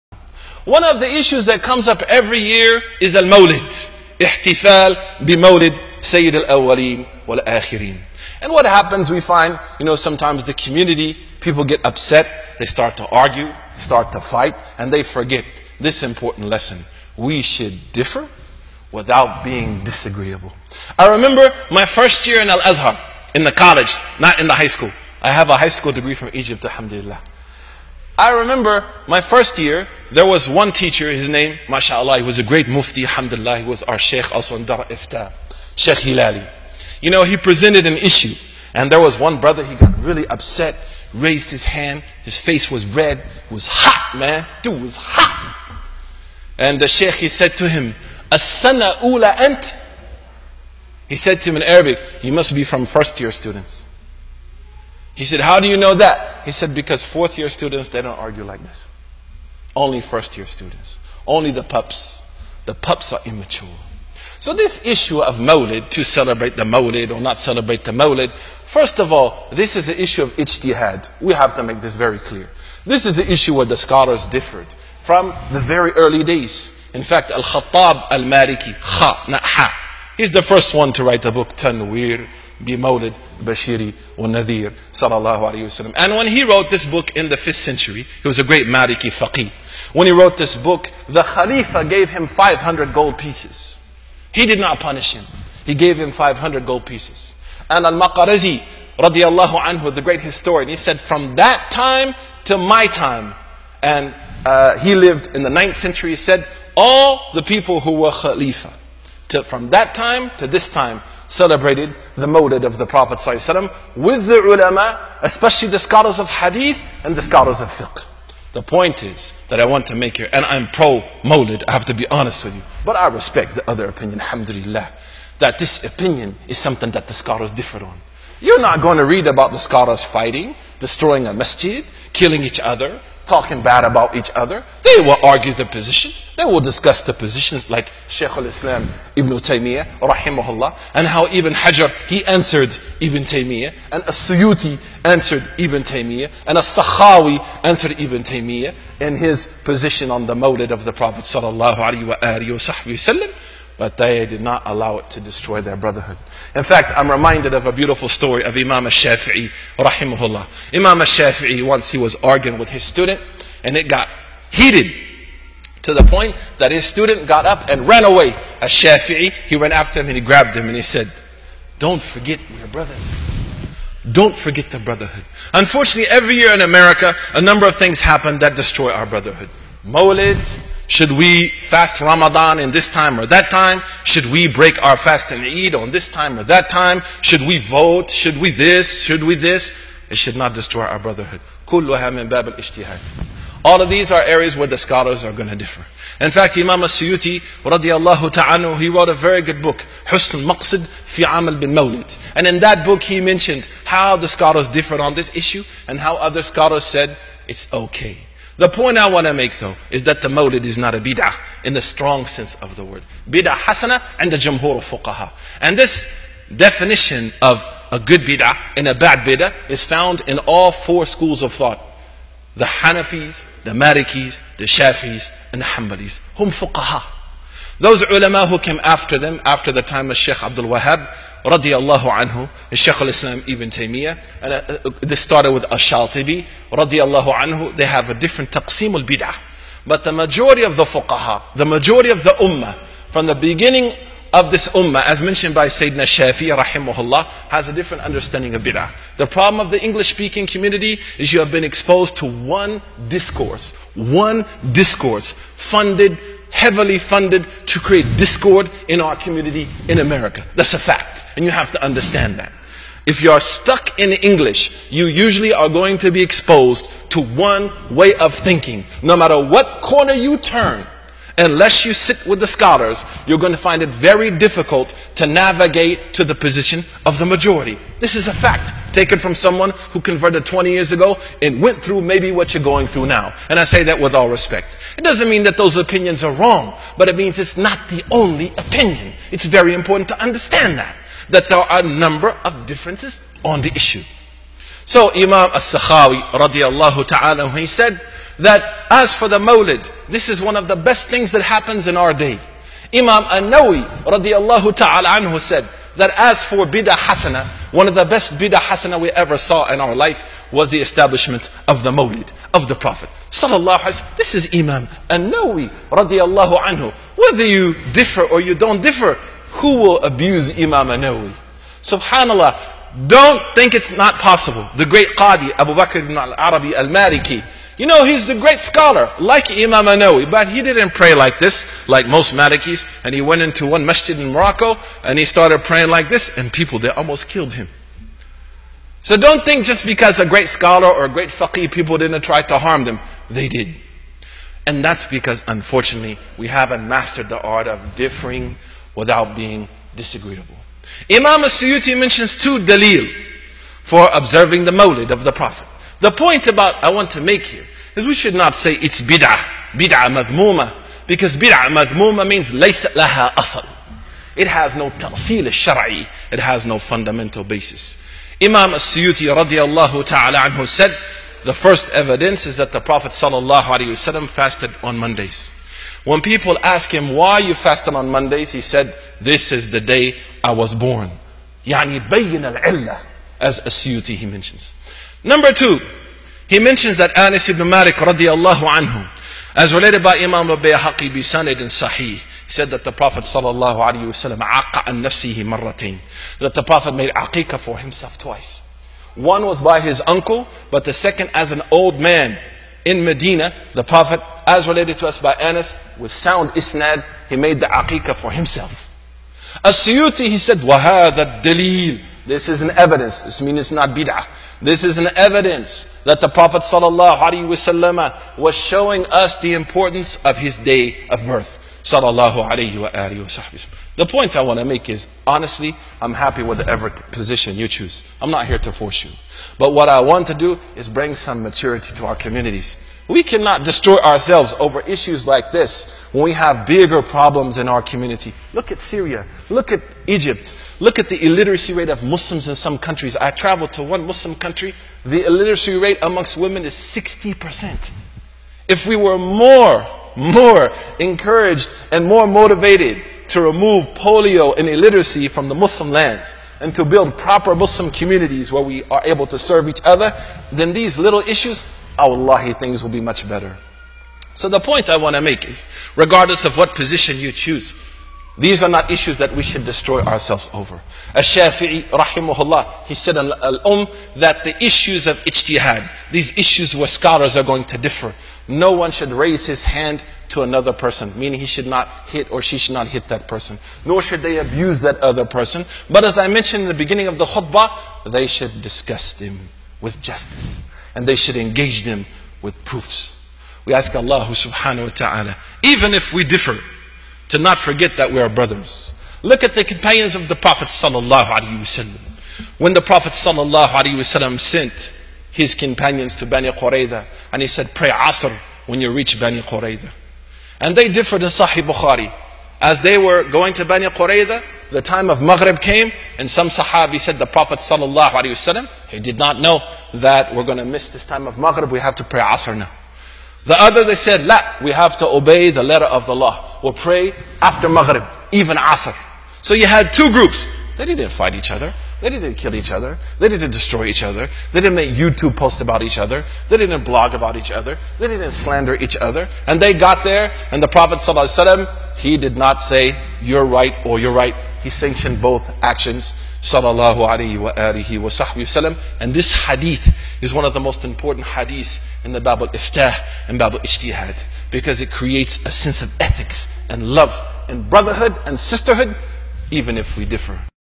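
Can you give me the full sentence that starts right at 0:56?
He said, because fourth year students, they don't argue like this.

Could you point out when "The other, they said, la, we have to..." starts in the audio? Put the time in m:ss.
8:43.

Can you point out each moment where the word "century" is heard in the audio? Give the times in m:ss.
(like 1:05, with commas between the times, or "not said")
1:27, 1:45.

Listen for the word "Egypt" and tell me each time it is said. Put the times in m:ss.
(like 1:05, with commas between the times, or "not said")
0:26, 7:20.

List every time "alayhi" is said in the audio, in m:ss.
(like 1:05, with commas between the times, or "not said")
6:13, 6:33, 9:07.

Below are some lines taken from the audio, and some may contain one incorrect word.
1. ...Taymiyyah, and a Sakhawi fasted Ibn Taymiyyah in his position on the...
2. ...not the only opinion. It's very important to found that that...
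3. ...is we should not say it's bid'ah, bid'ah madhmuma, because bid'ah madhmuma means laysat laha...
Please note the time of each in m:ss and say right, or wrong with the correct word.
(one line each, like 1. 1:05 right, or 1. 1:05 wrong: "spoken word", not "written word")
1. 2:25 wrong: "answered", not "fasted"
2. 4:47 wrong: "understand", not "found"
3. 5:57 right.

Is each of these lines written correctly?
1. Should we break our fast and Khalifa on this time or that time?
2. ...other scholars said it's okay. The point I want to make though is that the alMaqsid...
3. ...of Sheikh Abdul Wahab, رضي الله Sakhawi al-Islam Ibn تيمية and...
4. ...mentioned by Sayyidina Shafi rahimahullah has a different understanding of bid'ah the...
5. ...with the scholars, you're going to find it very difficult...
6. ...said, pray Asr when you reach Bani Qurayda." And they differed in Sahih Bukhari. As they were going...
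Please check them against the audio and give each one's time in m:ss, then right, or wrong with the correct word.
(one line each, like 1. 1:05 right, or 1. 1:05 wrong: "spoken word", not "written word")
1. 3:04 wrong: "Eid", not "Khalifa"
2. 3:26 wrong: "mawlid", not "alMaqsid"
3. 3:50 wrong: "Shaykh", not "Sakhawi"
4. 4:05 right
5. 4:32 right
6. 8:27 right.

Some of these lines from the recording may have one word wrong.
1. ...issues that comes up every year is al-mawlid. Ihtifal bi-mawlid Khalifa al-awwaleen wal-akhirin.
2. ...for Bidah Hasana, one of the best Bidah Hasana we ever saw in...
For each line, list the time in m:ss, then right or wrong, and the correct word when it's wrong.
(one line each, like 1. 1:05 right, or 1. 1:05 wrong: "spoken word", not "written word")
1. 0:01 wrong: "Sayyid", not "Khalifa"
2. 5:06 right.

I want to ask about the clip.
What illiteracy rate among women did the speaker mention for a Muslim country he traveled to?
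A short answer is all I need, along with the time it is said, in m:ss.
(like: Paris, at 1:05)
60%, at 7:26.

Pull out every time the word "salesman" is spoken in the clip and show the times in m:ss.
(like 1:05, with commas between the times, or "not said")
not said.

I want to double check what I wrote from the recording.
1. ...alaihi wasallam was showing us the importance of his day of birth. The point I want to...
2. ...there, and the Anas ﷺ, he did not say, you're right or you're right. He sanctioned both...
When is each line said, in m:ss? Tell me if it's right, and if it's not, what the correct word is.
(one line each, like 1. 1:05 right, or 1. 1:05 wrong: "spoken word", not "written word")
1. 6:57 right
2. 9:00 wrong: "Prophet", not "Anas".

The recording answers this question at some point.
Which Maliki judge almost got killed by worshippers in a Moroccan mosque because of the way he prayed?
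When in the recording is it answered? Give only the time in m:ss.
5:25.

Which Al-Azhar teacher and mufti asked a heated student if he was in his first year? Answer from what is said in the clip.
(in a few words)
Sheikh Hilali.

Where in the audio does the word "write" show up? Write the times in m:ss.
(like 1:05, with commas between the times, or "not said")
1:21.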